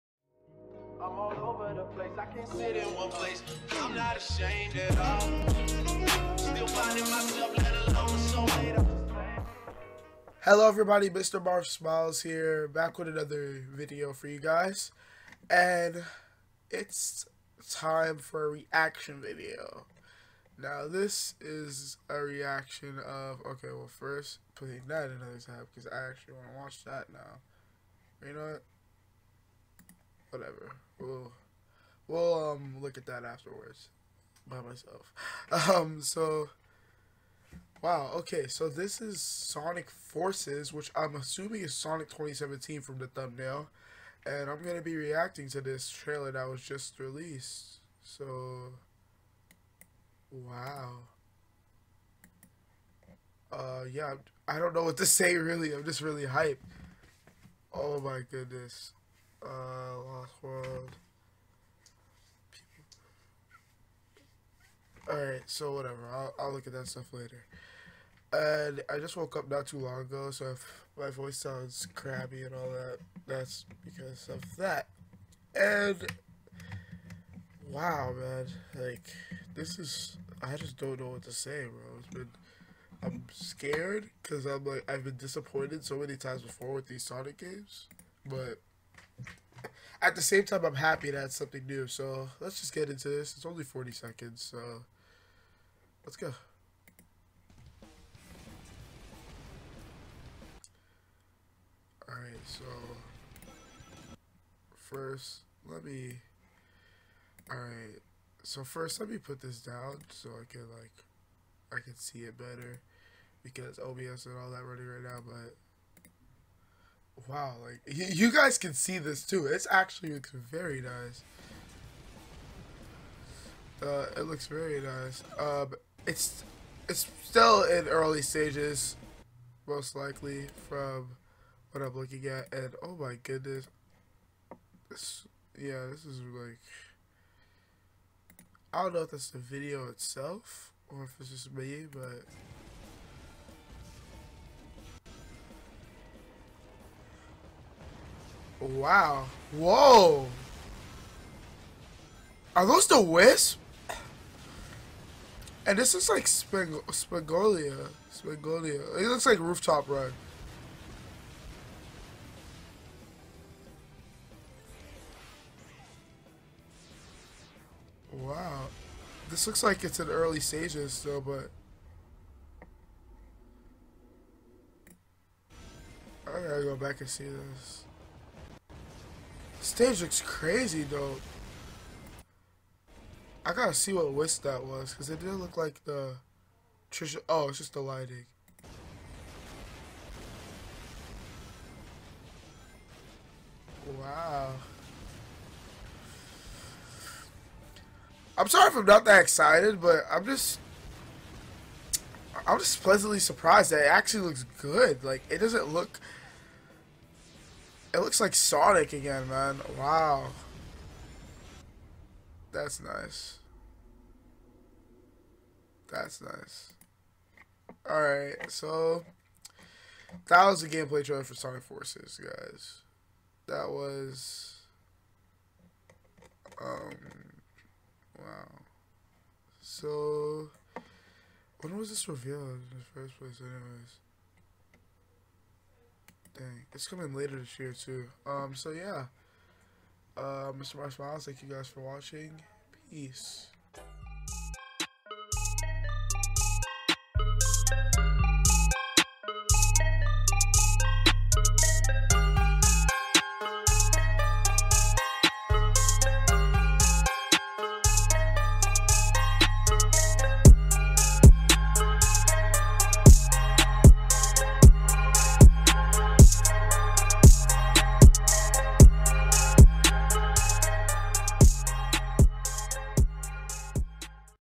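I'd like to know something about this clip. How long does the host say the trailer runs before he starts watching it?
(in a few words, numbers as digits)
40 seconds.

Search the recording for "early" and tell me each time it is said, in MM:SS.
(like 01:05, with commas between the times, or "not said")
02:07, 02:50.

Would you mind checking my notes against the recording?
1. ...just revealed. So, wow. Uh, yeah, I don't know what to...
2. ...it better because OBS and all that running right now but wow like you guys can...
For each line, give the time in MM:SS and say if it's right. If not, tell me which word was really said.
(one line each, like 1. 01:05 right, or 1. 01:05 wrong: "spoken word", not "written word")
1. 00:46 wrong: "released", not "revealed"
2. 01:52 right.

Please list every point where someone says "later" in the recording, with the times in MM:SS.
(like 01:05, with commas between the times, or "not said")
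01:07, 03:57.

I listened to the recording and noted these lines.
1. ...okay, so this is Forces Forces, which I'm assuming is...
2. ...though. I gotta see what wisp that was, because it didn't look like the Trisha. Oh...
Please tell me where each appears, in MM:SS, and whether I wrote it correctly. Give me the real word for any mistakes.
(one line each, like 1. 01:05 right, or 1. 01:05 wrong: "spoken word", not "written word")
1. 00:38 wrong: "Sonic", not "Forces"
2. 03:00 right.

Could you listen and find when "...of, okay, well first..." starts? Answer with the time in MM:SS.
00:23.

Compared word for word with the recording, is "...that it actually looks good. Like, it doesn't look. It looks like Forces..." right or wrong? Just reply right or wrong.
wrong.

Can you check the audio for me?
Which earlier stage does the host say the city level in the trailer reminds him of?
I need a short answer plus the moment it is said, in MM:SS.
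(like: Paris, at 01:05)
Rooftop Run, at 02:39.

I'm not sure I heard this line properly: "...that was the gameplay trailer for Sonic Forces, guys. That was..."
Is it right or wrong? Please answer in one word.
right.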